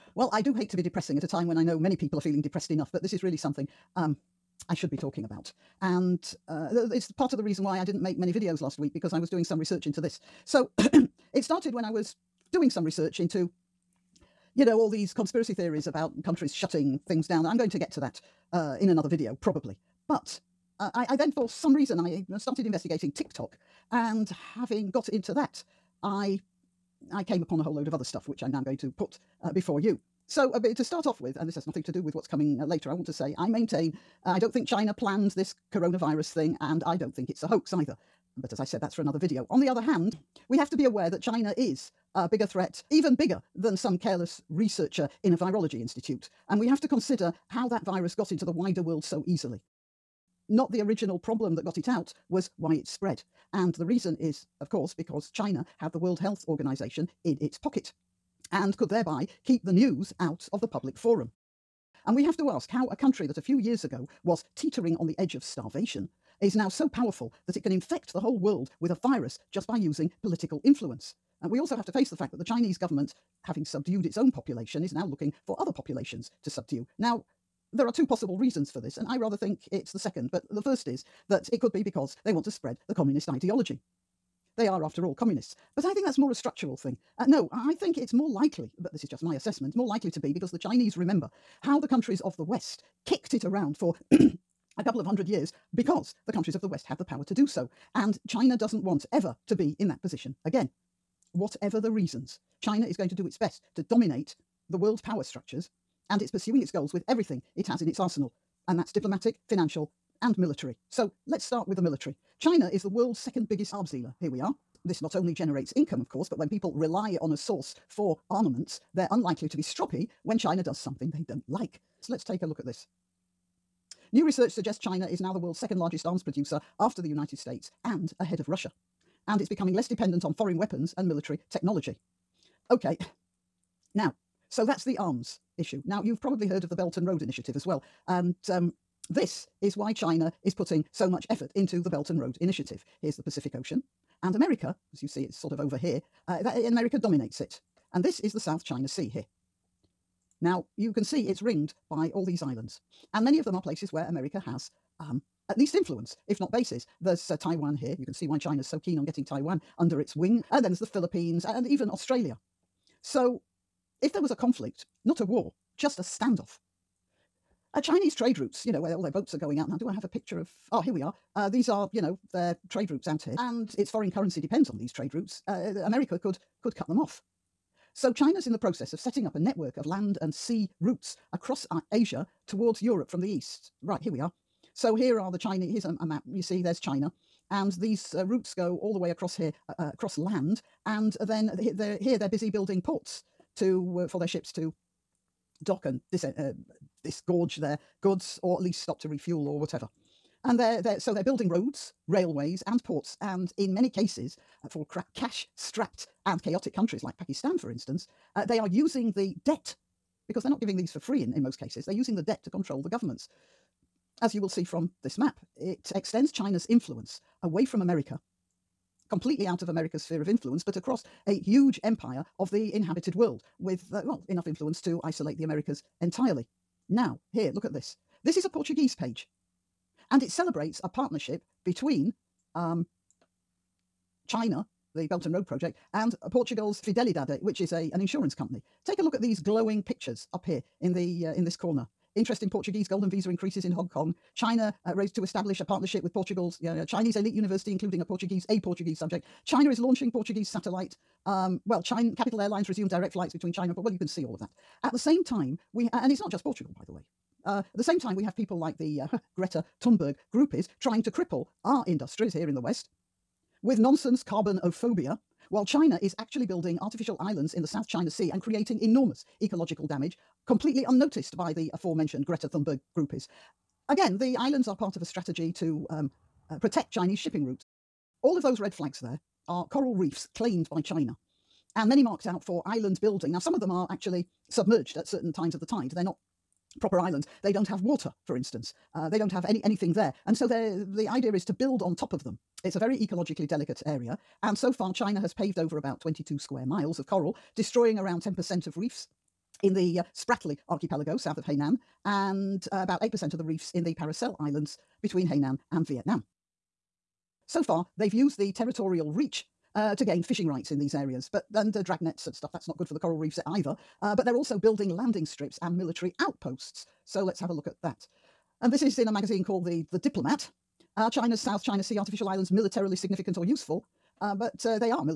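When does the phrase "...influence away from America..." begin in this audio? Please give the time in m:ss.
3:36.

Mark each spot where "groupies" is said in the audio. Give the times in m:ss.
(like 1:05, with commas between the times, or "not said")
4:20, 4:32.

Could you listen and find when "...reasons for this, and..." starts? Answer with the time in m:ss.
1:18.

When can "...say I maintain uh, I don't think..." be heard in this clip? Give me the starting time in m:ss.
0:33.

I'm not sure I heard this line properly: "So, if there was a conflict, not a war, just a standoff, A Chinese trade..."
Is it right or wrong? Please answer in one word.
right.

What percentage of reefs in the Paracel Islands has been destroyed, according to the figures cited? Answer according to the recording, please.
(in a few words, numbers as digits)
8%.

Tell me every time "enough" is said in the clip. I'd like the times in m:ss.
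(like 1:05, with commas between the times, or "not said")
0:02, 3:44.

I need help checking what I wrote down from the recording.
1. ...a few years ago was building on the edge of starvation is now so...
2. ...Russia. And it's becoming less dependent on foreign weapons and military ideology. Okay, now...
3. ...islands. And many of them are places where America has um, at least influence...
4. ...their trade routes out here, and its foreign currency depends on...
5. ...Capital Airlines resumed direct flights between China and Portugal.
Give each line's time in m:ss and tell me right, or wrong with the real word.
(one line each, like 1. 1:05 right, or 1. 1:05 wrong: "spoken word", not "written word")
1. 1:03 wrong: "teetering", not "building"
2. 2:08 wrong: "technology", not "ideology"
3. 2:32 right
4. 2:52 right
5. 4:12 right.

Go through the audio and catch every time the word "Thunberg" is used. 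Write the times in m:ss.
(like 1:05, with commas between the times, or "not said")
4:19, 4:32.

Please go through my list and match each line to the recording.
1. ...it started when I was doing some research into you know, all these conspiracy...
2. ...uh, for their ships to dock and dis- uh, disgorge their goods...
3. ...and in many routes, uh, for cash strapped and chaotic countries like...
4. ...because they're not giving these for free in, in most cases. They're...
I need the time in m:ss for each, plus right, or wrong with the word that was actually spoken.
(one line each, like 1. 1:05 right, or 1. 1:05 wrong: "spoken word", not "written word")
1. 0:10 right
2. 3:14 right
3. 3:23 wrong: "cases", not "routes"
4. 3:30 right.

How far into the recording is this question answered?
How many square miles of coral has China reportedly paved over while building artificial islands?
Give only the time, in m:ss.
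4:55.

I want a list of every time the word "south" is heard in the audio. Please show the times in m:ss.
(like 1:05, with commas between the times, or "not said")
2:28, 4:27, 5:01, 5:21.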